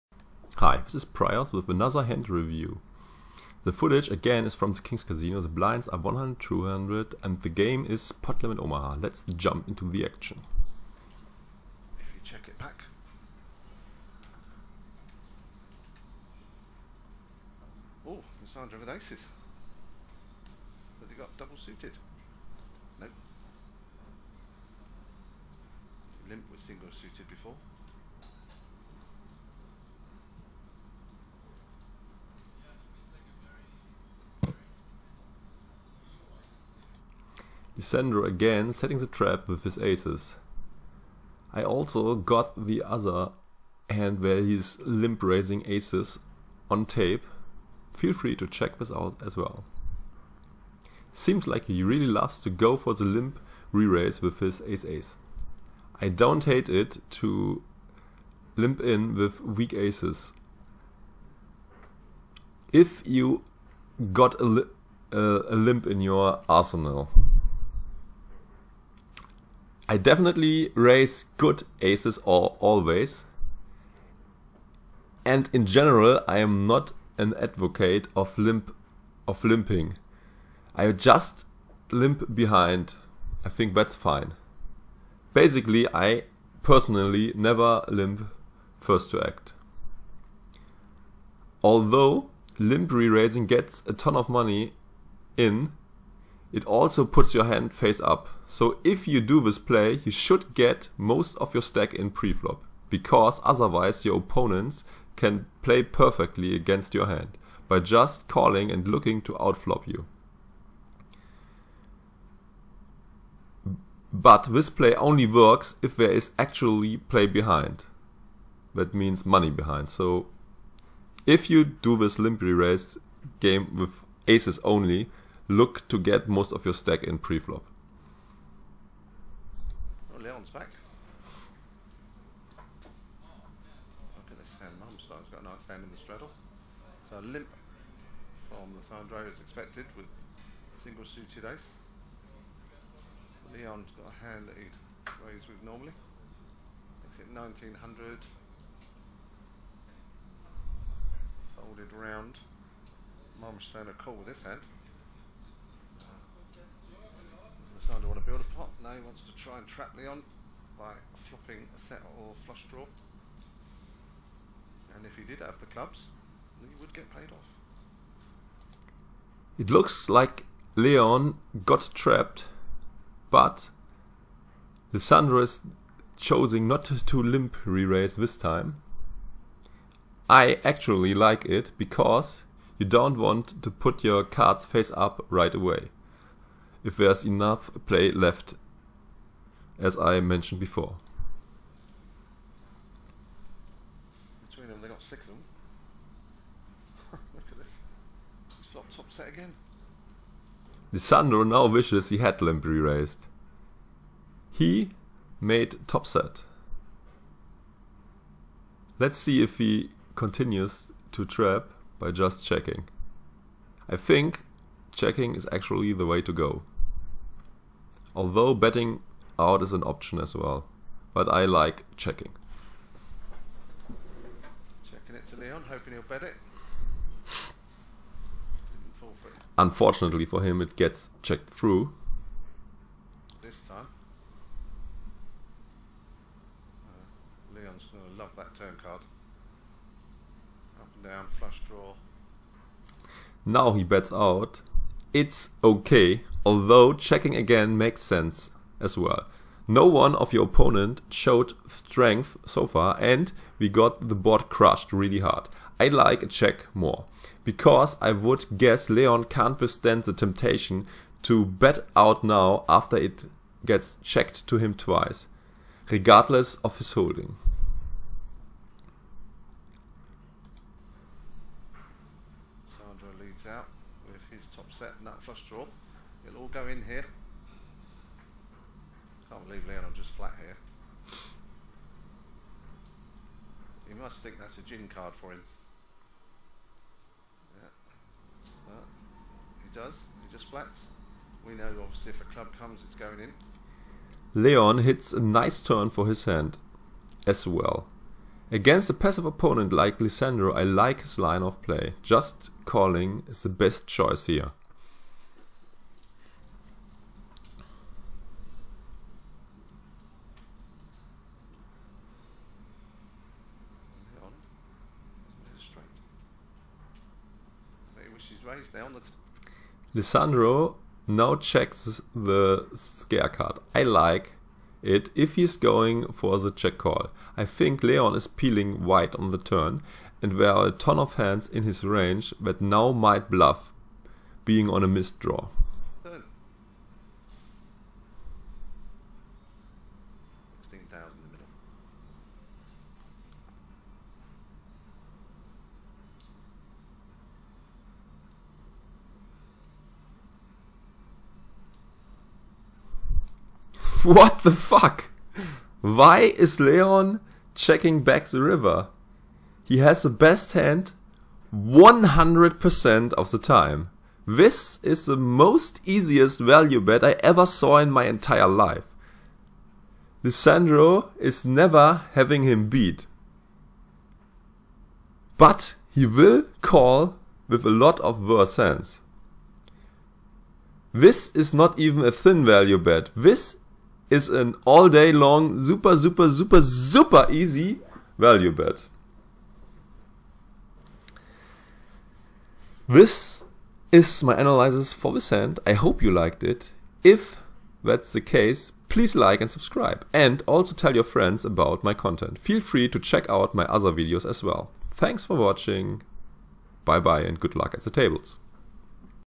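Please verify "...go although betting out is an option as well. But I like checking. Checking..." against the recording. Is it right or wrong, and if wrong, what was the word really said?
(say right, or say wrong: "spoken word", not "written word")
right.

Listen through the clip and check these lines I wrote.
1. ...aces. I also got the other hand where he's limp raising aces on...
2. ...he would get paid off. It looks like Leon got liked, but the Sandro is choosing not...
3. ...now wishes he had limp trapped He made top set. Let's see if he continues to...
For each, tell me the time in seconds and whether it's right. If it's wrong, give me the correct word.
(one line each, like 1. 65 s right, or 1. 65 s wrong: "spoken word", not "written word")
1. 39 s right
2. 166 s wrong: "trapped", not "liked"
3. 201 s wrong: "raised", not "trapped".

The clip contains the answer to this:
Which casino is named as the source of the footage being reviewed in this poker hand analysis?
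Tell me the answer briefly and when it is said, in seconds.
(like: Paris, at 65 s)
King's Casino, at 4 s.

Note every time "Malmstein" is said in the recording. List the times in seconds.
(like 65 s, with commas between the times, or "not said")
153 s.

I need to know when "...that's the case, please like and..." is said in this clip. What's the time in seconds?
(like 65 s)
397 s.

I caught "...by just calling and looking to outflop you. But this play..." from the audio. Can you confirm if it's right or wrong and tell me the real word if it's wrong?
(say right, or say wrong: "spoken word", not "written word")
right.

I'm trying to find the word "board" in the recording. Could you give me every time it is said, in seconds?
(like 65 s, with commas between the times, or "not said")
254 s.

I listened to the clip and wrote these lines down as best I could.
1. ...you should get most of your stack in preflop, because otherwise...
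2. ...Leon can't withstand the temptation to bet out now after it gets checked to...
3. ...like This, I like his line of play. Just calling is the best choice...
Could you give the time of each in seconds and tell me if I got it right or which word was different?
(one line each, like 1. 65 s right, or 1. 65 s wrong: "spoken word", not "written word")
1. 100 s right
2. 258 s right
3. 299 s wrong: "Lisandro", not "This".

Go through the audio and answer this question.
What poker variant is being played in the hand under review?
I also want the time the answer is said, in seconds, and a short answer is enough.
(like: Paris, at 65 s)
Pot Limit Omaha, at 8 s.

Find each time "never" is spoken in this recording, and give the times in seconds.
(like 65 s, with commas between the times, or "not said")
87 s, 371 s.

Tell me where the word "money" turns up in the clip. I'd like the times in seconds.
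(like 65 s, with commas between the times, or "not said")
94 s, 119 s.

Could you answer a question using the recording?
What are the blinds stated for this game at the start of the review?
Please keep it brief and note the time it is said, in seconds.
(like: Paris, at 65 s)
100, 200, at 5 s.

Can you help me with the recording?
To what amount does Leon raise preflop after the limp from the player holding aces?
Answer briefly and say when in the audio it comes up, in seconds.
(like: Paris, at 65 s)
1900, at 147 s.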